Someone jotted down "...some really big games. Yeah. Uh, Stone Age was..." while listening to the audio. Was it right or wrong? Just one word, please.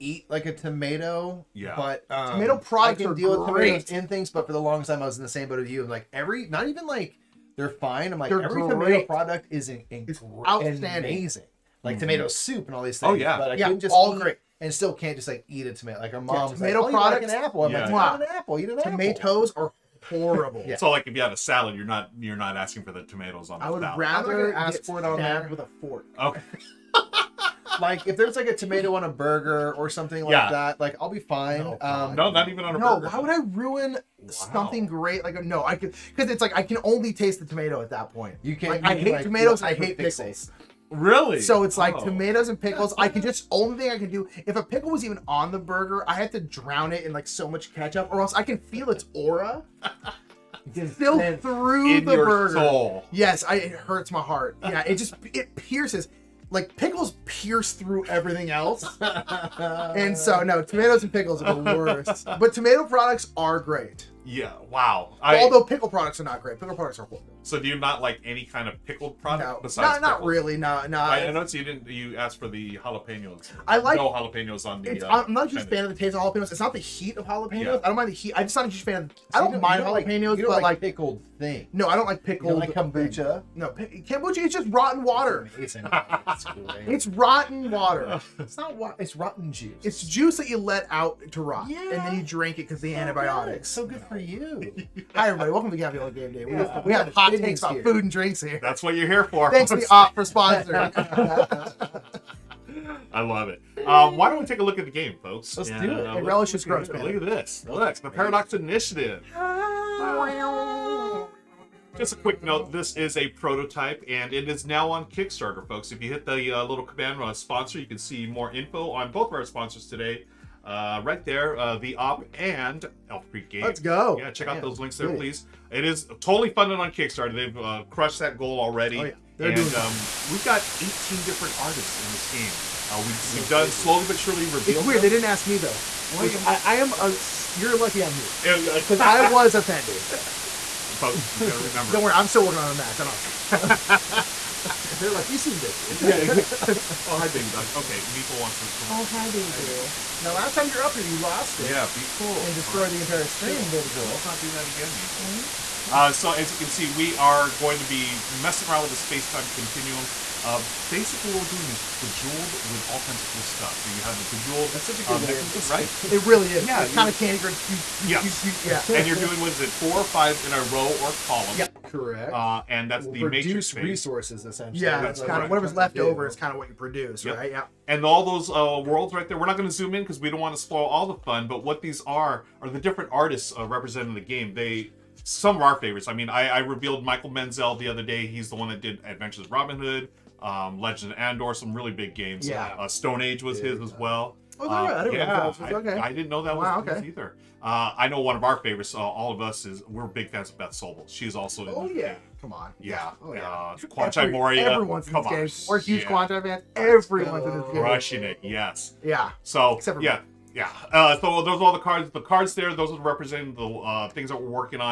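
right.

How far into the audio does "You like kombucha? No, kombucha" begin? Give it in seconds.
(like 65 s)
82 s.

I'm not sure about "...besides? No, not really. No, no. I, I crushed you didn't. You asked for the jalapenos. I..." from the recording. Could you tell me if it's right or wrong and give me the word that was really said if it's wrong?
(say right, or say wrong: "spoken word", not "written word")
wrong: "noticed", not "crushed".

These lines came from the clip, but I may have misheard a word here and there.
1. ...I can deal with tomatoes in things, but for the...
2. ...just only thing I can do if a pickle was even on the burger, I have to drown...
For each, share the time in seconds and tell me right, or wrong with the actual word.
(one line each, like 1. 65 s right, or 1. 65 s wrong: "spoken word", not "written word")
1. 3 s right
2. 43 s right.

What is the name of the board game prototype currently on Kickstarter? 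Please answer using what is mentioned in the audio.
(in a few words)
The Paradox Initiative.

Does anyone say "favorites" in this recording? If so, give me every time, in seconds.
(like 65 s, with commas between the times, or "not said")
185 s, 198 s.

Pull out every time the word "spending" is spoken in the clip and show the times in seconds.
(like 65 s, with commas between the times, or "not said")
not said.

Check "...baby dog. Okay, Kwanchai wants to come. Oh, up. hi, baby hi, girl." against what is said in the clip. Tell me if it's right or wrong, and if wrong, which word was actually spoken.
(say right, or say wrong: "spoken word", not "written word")
wrong: "Meeple", not "Kwanchai".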